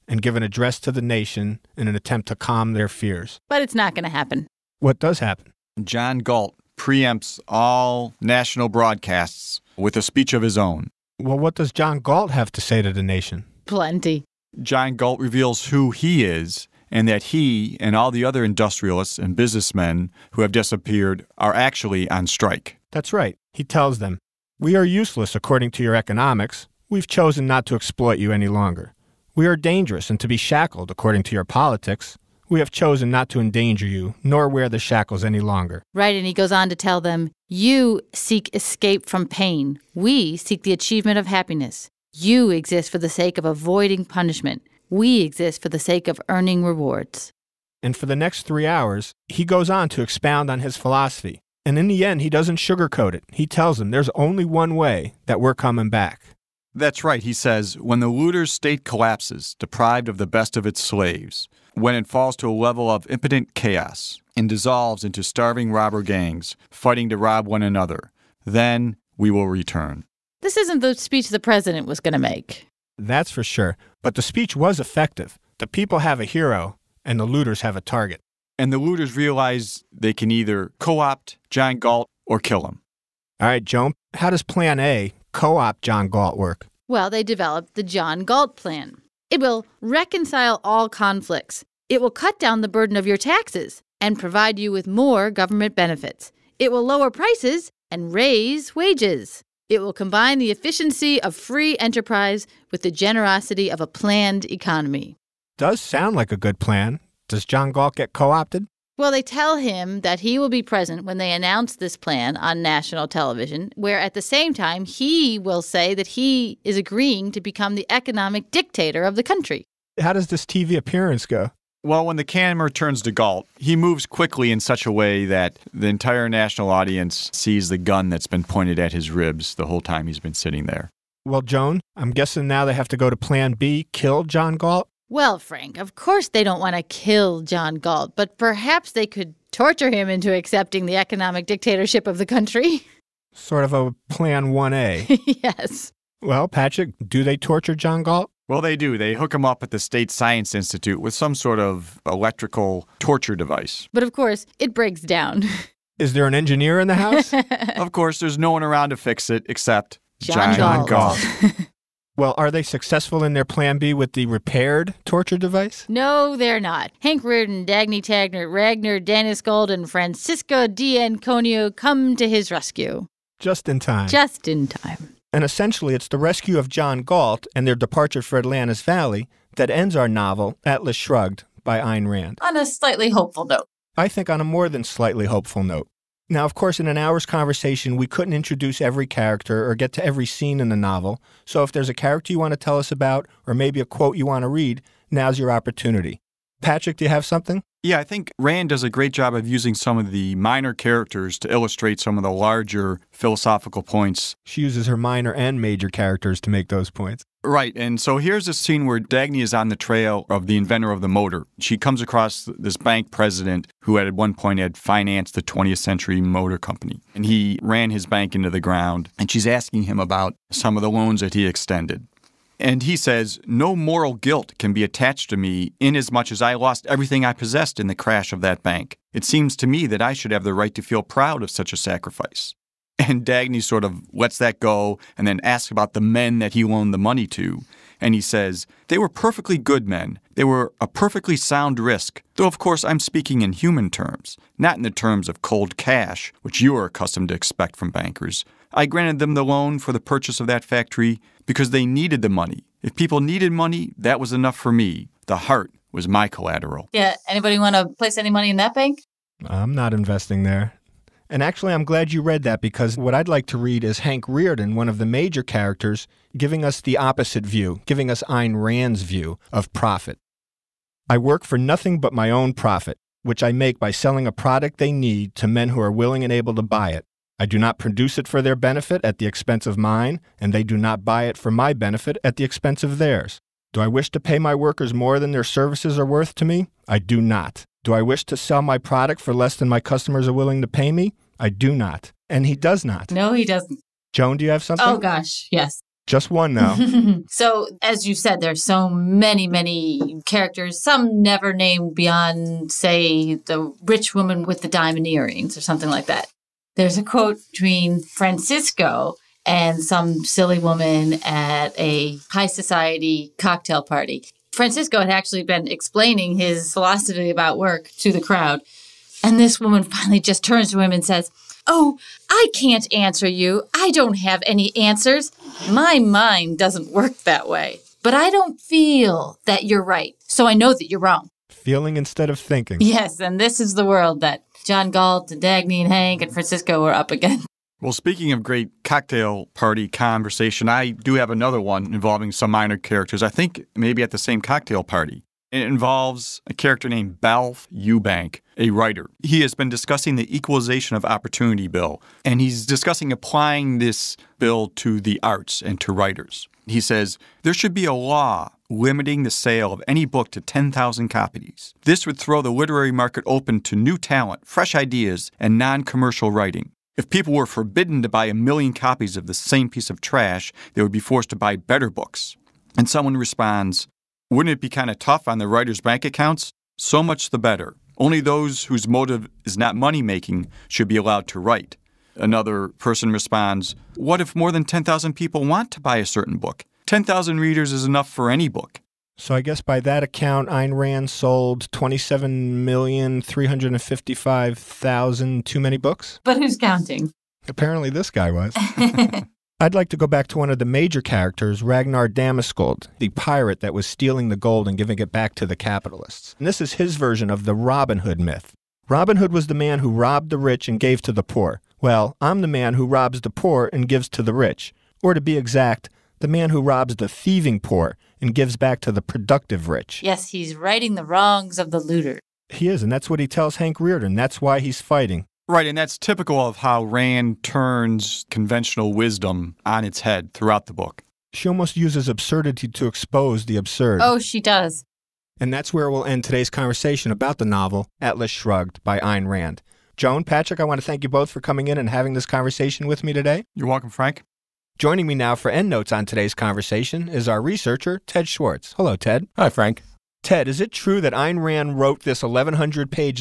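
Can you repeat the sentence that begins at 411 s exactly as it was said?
Well, I'm the man who robs the poor and gives to the rich.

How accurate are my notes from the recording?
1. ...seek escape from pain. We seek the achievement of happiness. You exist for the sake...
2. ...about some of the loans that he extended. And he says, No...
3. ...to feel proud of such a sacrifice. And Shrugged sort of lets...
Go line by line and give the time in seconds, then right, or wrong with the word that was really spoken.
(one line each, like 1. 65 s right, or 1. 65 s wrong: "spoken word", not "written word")
1. 38 s right
2. 219 s right
3. 230 s wrong: "Dagny", not "Shrugged".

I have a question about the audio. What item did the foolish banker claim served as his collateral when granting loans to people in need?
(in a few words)
The heart.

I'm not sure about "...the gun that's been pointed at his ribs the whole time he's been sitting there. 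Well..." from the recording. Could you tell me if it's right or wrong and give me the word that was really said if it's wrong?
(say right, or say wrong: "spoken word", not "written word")
right.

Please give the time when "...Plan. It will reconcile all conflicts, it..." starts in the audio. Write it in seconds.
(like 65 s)
88 s.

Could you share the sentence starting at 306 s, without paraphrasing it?
There's a quote between Francisco and some silly woman at a high society cocktail party.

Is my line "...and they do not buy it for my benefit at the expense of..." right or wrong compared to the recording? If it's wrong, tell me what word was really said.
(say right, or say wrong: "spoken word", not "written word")
right.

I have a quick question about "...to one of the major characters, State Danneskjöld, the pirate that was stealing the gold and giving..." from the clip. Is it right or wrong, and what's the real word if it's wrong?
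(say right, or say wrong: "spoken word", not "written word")
wrong: "Ragnar", not "State".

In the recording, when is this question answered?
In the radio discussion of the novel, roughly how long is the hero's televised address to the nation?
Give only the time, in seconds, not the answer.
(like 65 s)
48 s.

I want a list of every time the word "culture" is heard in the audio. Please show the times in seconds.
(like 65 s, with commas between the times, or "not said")
not said.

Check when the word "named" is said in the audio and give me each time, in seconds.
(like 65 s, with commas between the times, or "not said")
301 s, 346 s.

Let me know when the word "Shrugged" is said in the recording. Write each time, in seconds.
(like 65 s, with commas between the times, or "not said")
180 s, 438 s.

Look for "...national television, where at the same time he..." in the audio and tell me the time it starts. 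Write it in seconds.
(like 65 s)
112 s.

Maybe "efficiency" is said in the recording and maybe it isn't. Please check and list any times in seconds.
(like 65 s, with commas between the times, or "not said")
100 s.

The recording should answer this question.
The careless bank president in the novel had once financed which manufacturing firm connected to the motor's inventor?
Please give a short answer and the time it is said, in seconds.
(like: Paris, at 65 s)
20th Century Motor Company, at 215 s.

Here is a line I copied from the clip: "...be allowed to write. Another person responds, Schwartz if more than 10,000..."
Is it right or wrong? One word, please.
wrong.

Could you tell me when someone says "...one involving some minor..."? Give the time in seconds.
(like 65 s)
341 s.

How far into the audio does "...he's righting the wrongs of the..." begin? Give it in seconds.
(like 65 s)
420 s.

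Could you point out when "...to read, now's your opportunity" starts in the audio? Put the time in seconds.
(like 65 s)
194 s.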